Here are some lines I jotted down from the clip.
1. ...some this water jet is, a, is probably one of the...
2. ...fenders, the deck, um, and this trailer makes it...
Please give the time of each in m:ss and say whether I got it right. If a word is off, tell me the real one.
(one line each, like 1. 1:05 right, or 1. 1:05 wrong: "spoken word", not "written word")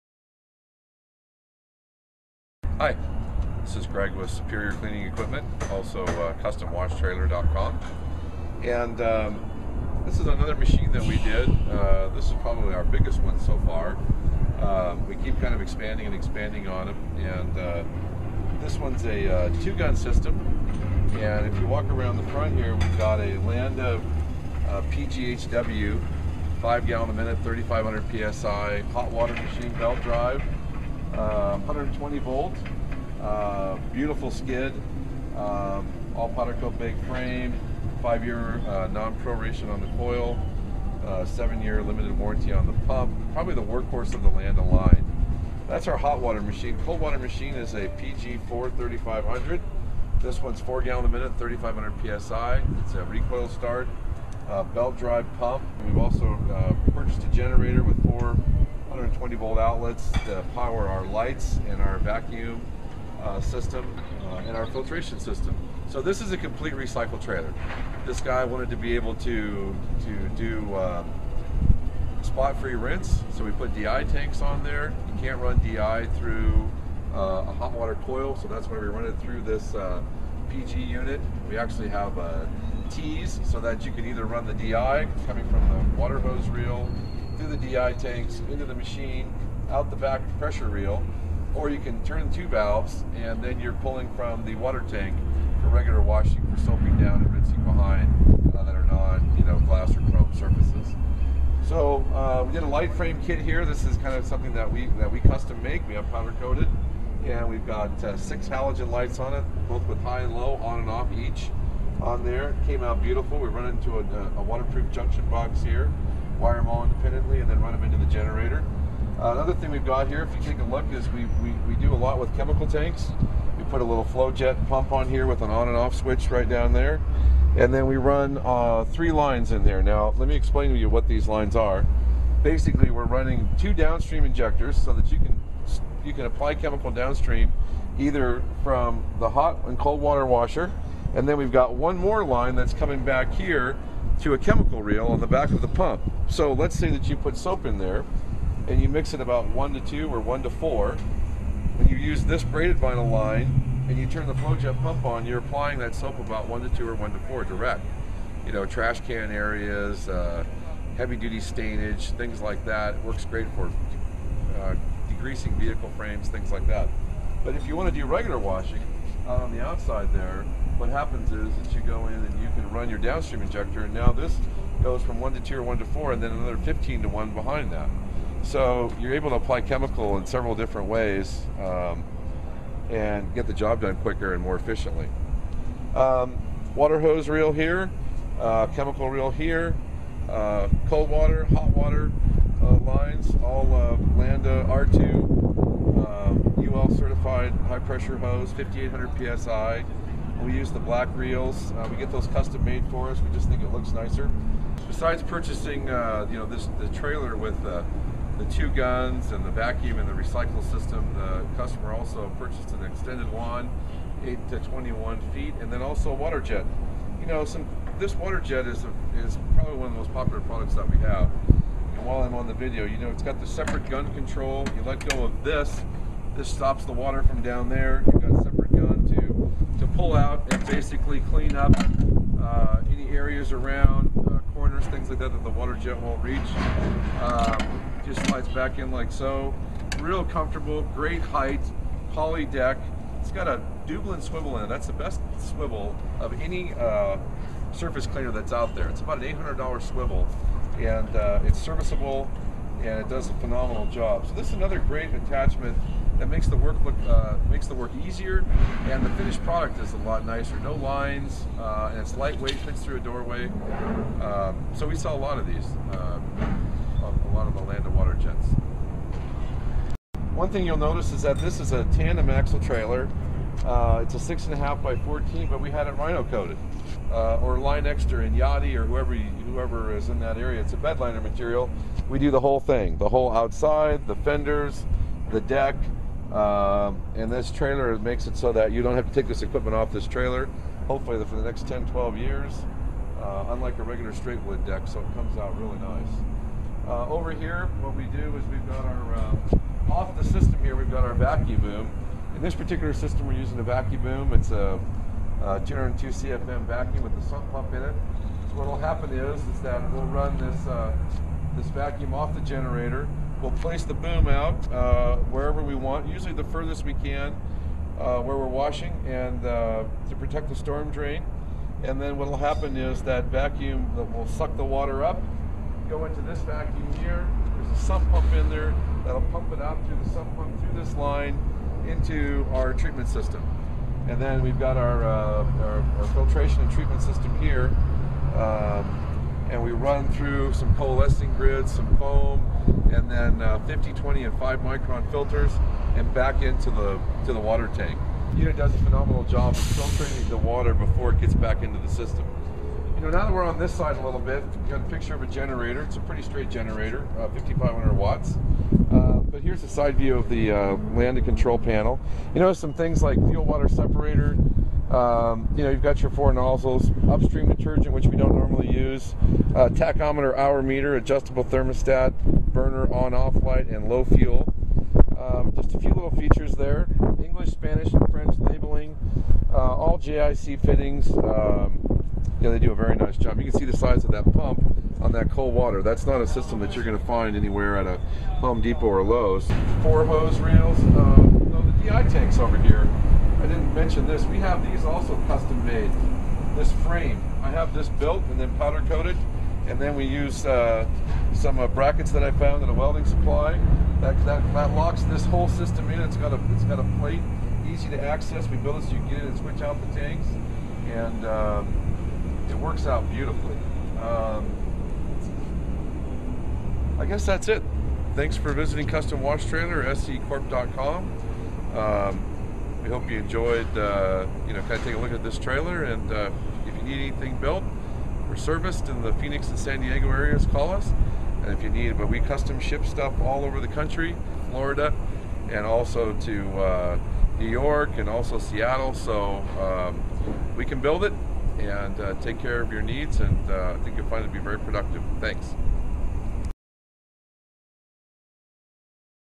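1. 3:37 right
2. 4:44 right.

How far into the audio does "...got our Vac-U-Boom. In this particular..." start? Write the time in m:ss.
5:00.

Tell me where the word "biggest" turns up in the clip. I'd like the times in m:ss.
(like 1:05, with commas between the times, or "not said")
0:12.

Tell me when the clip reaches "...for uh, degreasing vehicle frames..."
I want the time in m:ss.
2:43.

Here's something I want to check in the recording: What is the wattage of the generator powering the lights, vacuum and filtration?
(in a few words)
5,500 watts.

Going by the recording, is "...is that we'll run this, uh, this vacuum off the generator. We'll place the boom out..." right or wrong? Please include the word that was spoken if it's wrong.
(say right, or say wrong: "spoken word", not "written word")
right.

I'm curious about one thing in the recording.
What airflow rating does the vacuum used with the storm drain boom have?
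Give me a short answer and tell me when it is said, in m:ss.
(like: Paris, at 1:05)
202 CFM, at 5:05.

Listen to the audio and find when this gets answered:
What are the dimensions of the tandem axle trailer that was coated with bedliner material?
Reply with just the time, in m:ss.
4:34.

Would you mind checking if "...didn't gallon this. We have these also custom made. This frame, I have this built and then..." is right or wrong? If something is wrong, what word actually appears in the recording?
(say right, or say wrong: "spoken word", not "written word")
wrong: "mention", not "gallon".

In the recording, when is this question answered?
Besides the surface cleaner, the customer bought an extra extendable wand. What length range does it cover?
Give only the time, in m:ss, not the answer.
3:34.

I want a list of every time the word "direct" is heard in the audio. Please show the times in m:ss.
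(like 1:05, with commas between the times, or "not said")
2:37.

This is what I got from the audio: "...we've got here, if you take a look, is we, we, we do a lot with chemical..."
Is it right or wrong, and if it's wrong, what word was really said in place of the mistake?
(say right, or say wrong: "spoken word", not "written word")
right.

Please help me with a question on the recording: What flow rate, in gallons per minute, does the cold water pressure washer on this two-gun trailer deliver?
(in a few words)
4.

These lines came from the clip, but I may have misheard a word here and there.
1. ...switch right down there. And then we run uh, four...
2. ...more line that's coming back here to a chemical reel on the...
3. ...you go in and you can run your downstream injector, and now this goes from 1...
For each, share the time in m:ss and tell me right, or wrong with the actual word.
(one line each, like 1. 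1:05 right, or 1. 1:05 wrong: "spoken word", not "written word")
1. 2:05 wrong: "three", not "four"
2. 2:21 right
3. 2:51 right.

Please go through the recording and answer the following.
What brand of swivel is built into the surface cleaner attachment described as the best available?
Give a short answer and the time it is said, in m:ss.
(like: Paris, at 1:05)
Dublin, at 4:03.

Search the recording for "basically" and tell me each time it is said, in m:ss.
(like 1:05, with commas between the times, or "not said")
2:12, 3:50.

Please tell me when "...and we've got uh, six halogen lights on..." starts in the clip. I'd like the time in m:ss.
1:47.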